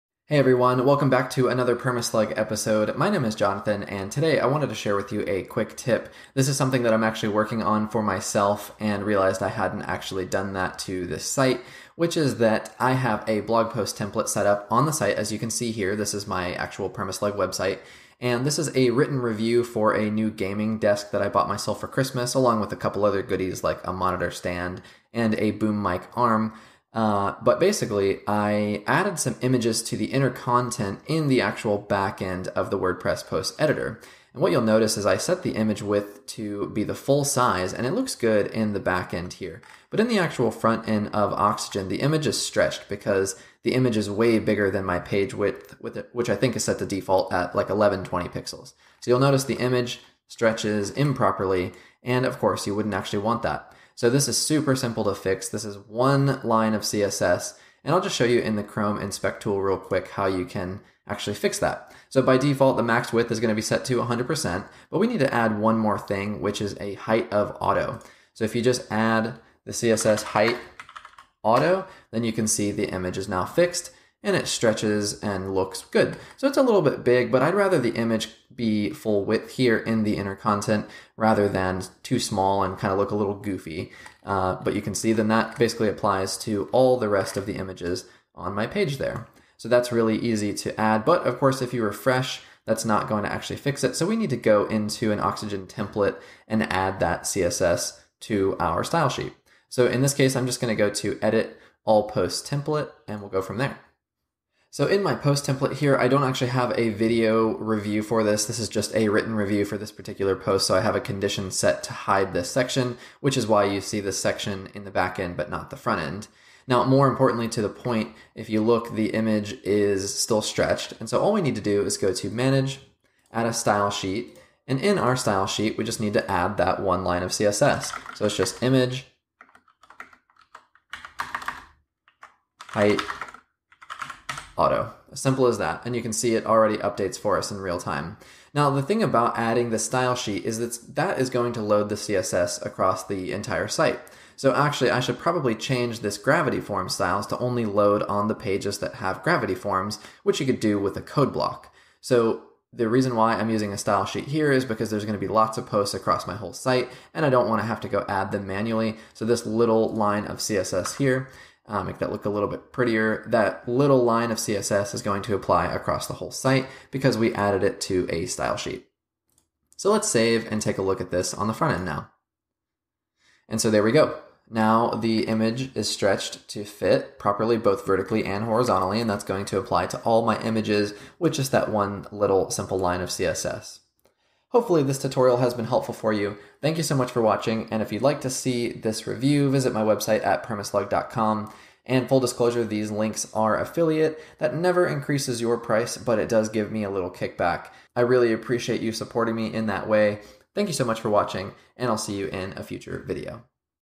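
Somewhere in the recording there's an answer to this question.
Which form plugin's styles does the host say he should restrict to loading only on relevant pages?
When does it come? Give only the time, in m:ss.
2:26.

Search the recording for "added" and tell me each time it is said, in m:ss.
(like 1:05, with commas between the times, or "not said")
0:28, 2:47.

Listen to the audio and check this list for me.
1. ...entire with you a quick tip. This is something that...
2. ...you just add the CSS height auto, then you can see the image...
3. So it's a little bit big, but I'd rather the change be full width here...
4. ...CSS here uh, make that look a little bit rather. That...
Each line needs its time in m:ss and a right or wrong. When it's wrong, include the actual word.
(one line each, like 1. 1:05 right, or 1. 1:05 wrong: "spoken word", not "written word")
1. 0:04 wrong: "share", not "entire"
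2. 1:08 right
3. 1:16 wrong: "image", not "change"
4. 2:40 wrong: "prettier", not "rather".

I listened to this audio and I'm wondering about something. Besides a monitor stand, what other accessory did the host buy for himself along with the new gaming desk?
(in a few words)
boom mic arm.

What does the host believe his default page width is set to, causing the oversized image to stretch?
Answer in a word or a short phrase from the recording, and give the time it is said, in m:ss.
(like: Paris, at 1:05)
1120 pixels, at 0:47.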